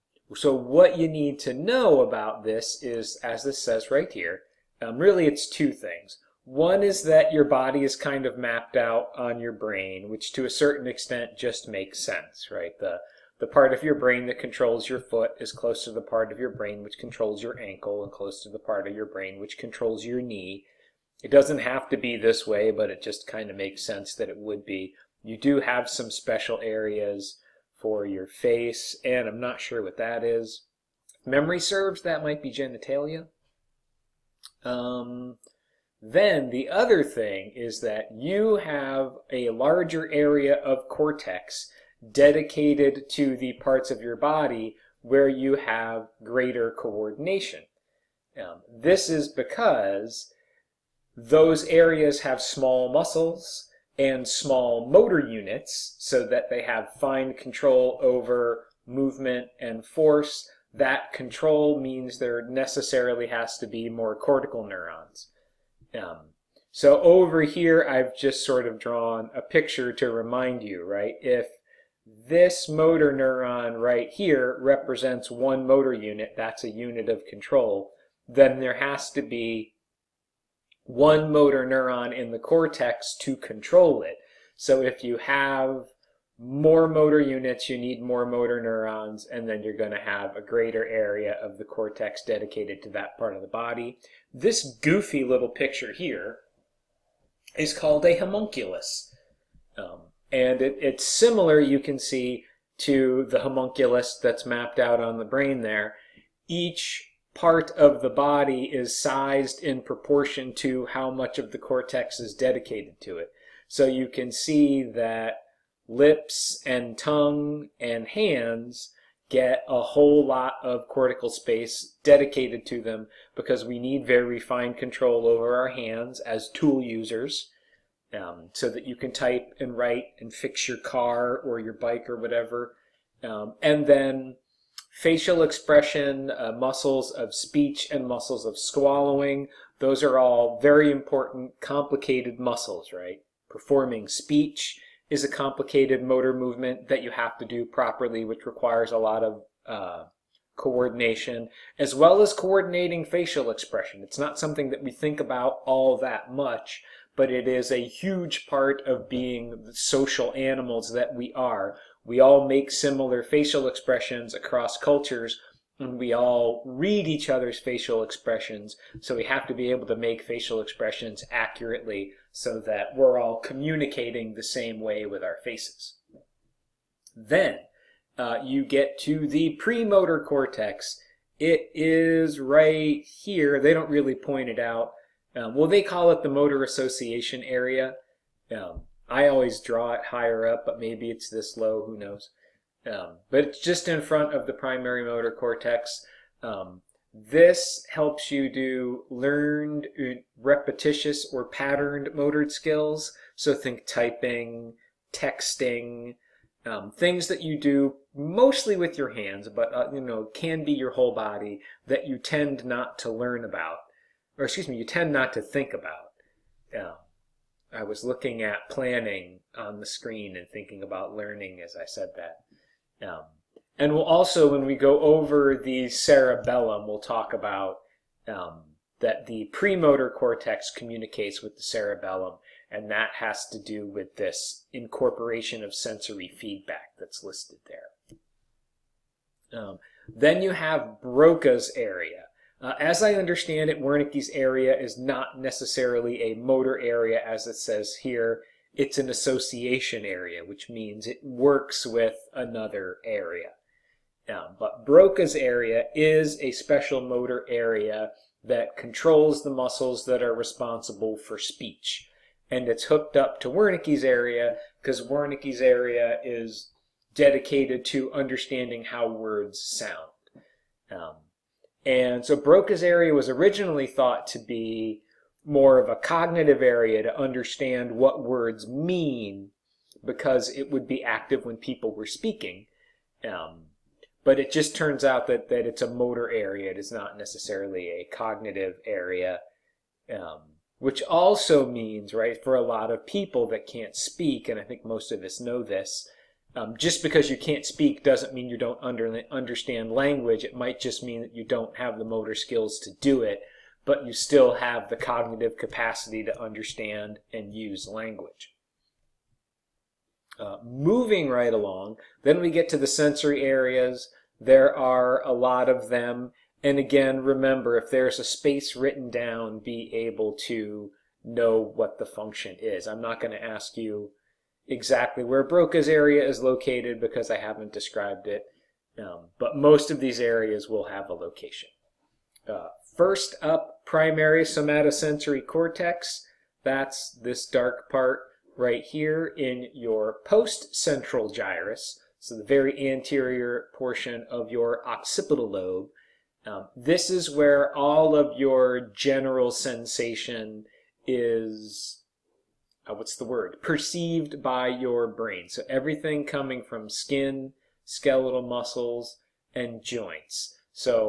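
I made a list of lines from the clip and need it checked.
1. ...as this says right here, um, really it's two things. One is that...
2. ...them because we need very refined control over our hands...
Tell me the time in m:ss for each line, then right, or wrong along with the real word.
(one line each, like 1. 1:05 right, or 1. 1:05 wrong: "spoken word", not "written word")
1. 0:03 right
2. 2:02 right.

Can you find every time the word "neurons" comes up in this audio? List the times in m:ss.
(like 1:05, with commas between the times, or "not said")
1:04, 1:13, 1:21, 1:28.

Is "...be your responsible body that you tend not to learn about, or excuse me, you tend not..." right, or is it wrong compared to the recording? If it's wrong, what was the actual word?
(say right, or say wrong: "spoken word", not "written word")
wrong: "whole", not "responsible".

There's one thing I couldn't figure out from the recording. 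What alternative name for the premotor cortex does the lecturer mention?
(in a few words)
motor association area.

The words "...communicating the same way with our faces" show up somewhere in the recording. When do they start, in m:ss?
2:53.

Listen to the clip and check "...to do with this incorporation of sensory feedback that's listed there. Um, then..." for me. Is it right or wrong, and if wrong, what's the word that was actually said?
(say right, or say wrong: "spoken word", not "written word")
right.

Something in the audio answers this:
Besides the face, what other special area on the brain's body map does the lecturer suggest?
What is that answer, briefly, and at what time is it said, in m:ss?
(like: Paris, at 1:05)
genitalia, at 0:32.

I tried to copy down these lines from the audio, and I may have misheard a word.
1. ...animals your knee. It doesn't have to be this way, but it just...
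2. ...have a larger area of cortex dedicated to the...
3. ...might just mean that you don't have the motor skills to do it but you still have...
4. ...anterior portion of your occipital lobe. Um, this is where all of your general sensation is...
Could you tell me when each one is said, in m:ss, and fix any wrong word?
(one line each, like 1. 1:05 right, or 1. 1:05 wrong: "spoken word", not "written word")
1. 0:19 wrong: "controls", not "animals"
2. 0:38 right
3. 5:00 right
4. 5:42 right.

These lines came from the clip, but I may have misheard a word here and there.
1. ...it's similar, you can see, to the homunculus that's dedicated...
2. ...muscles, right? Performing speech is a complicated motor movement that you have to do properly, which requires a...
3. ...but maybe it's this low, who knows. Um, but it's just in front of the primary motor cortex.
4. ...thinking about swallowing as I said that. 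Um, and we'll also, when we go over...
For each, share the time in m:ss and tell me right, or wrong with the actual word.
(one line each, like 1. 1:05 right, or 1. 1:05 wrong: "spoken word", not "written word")
1. 1:40 wrong: "mapped", not "dedicated"
2. 2:22 right
3. 3:10 right
4. 3:40 wrong: "learning", not "swallowing".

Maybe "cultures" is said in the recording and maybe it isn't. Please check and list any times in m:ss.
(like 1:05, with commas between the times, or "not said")
2:44.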